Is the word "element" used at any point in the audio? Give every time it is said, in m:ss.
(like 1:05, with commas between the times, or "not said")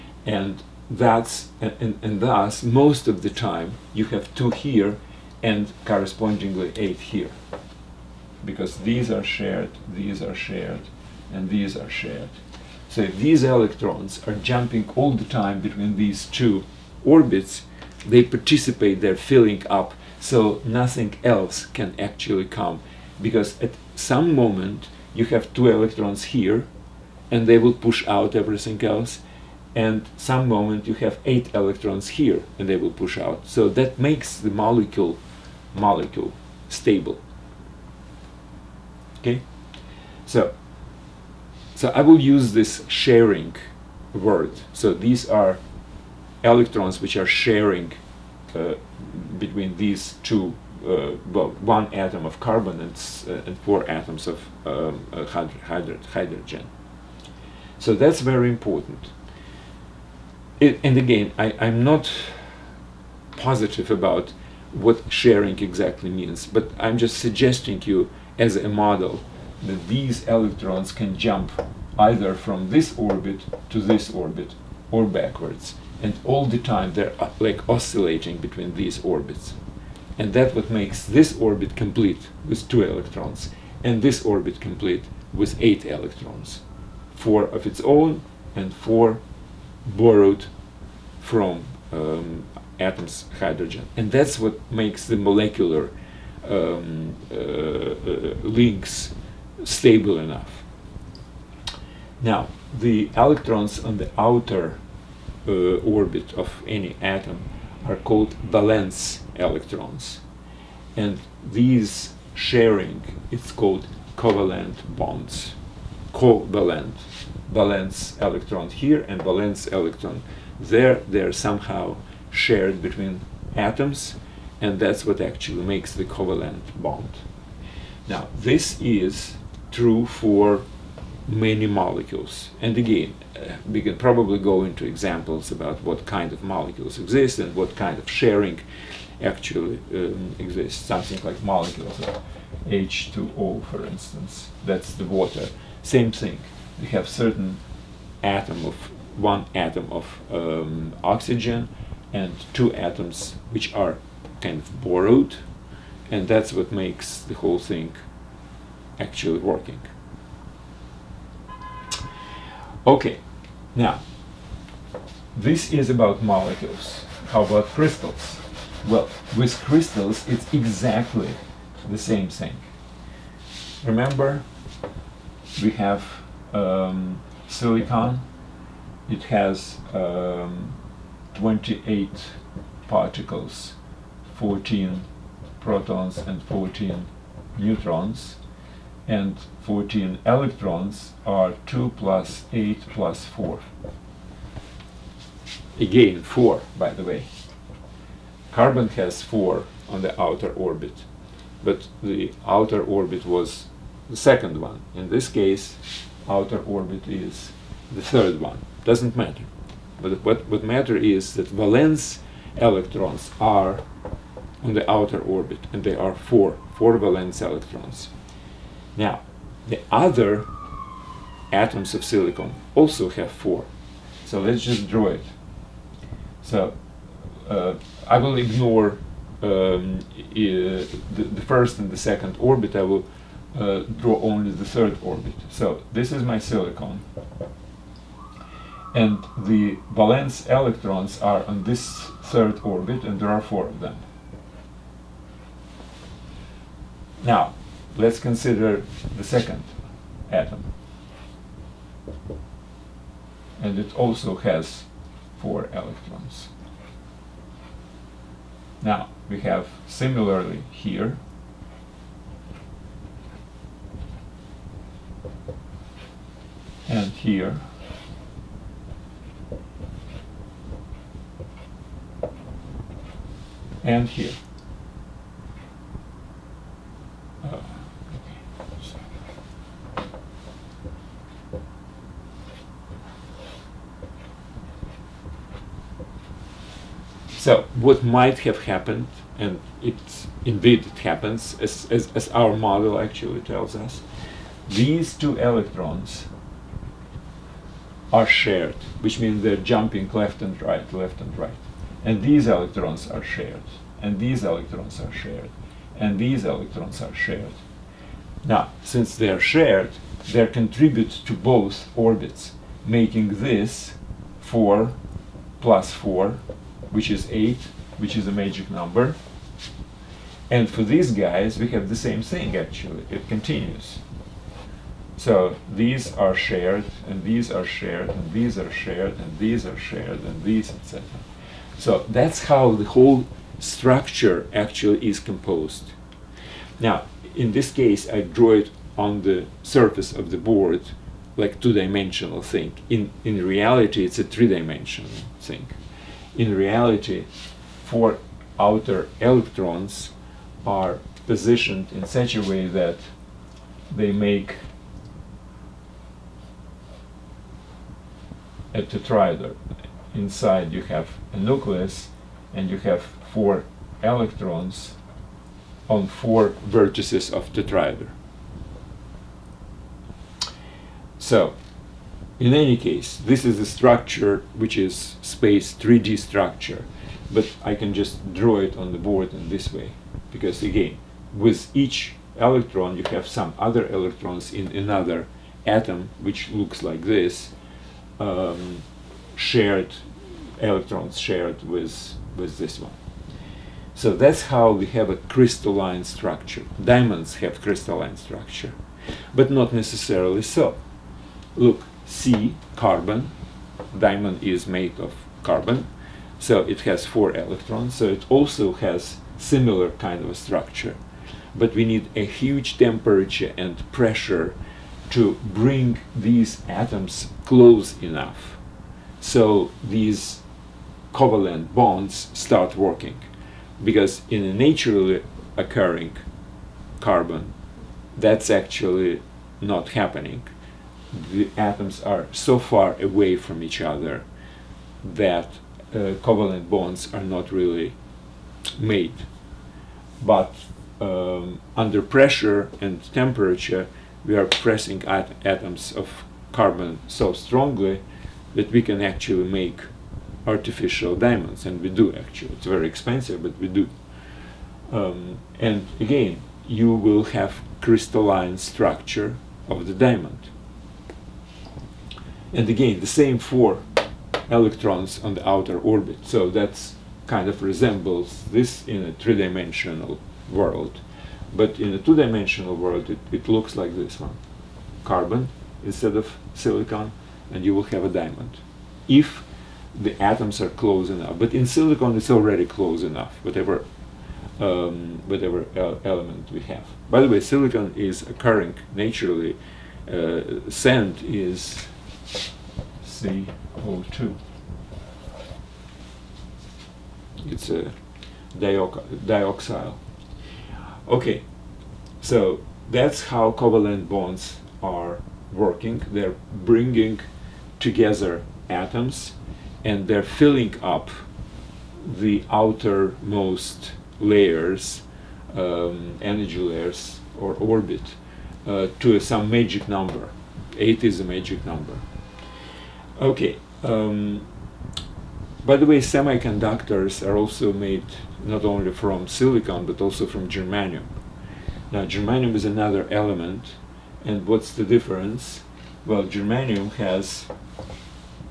8:06, 8:53.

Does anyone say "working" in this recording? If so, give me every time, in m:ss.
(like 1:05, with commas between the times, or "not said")
2:39, 7:02, 8:25.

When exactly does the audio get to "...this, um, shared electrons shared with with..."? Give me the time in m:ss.
6:27.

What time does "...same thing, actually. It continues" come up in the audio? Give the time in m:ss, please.
5:21.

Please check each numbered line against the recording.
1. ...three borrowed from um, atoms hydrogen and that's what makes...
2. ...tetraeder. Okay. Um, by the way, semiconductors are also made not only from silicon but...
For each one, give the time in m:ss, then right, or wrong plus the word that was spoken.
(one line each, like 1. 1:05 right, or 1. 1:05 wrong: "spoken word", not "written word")
1. 1:28 wrong: "four", not "three"
2. 8:41 wrong: "number", not "tetraeder".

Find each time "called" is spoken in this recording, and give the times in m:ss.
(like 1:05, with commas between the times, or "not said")
1:47, 1:53.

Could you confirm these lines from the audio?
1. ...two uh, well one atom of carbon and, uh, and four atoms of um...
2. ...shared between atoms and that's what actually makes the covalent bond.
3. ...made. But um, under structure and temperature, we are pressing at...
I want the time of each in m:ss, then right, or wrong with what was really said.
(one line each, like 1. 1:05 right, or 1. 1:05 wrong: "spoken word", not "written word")
1. 0:50 right
2. 2:02 right
3. 7:18 wrong: "pressure", not "structure".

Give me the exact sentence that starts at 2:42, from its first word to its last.
Okay, now this is about molecules.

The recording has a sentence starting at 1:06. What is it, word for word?
But I'm just suggesting you as a model that these electrons can jump either from this orbit to this orbit or backwards.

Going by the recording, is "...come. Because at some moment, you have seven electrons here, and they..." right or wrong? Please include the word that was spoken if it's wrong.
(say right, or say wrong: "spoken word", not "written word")
wrong: "two", not "seven".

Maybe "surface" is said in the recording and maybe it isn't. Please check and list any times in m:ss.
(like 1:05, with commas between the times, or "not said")
5:39.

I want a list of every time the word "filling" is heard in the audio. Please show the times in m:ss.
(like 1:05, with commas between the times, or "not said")
0:19, 8:30.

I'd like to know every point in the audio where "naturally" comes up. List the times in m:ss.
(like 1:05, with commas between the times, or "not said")
7:04, 8:08.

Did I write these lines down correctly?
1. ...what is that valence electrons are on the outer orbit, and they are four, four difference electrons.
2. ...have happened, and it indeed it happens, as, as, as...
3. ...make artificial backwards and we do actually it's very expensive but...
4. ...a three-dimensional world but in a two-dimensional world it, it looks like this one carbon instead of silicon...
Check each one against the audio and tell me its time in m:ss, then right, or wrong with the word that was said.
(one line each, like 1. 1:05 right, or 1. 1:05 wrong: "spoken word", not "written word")
1. 3:30 wrong: "valence", not "difference"
2. 4:48 right
3. 7:29 wrong: "diamonds", not "backwards"
4. 7:49 right.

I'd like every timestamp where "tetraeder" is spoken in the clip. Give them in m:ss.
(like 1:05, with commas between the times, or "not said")
5:58, 6:07.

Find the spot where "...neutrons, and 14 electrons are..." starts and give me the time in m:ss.
3:07.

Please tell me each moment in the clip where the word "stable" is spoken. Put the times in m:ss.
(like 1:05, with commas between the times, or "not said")
0:36, 1:39.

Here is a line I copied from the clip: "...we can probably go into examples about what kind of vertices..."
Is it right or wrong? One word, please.
wrong.